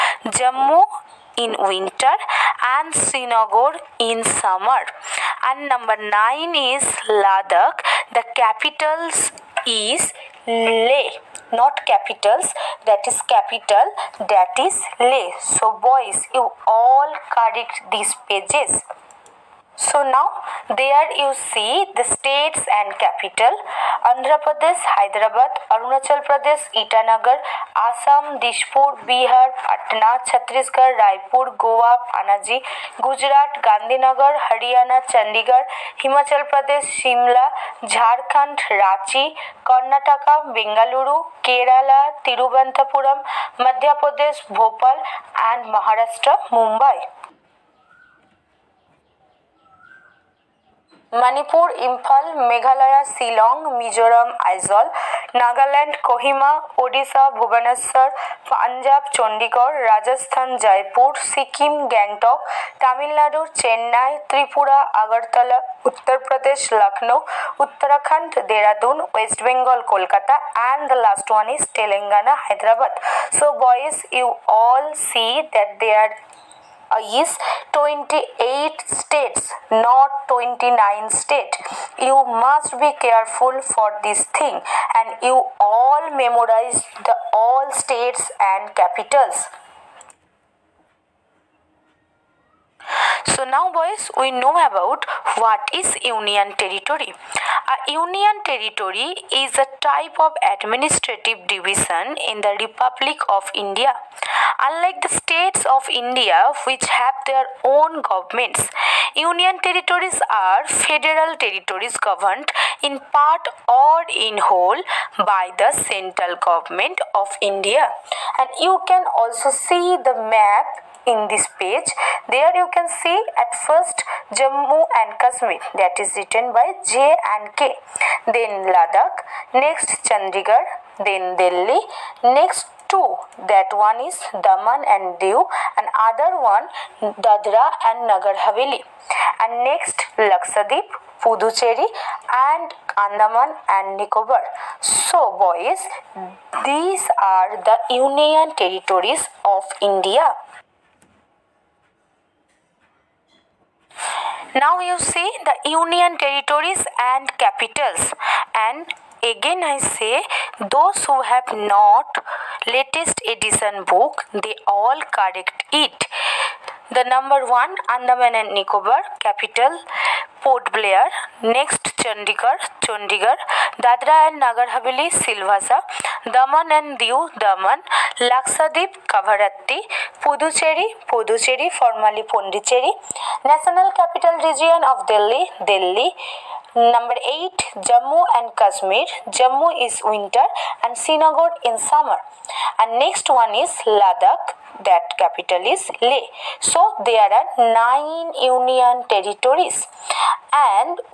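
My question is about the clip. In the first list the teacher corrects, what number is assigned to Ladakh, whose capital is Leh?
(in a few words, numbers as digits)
9.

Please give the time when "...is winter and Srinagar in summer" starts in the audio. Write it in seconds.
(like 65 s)
189 s.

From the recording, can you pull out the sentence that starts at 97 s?
A union territory is a type of administrative division in the Republic of India.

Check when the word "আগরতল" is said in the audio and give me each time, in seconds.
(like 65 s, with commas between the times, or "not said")
65 s.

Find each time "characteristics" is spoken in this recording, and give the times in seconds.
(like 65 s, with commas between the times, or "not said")
not said.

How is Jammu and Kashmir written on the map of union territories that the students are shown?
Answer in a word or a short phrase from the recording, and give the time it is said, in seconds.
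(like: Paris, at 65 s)
J and K, at 126 s.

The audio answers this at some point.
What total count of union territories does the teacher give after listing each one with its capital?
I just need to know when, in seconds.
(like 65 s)
197 s.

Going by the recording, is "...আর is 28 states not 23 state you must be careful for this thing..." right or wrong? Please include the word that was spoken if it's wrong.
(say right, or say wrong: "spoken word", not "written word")
wrong: "29", not "23".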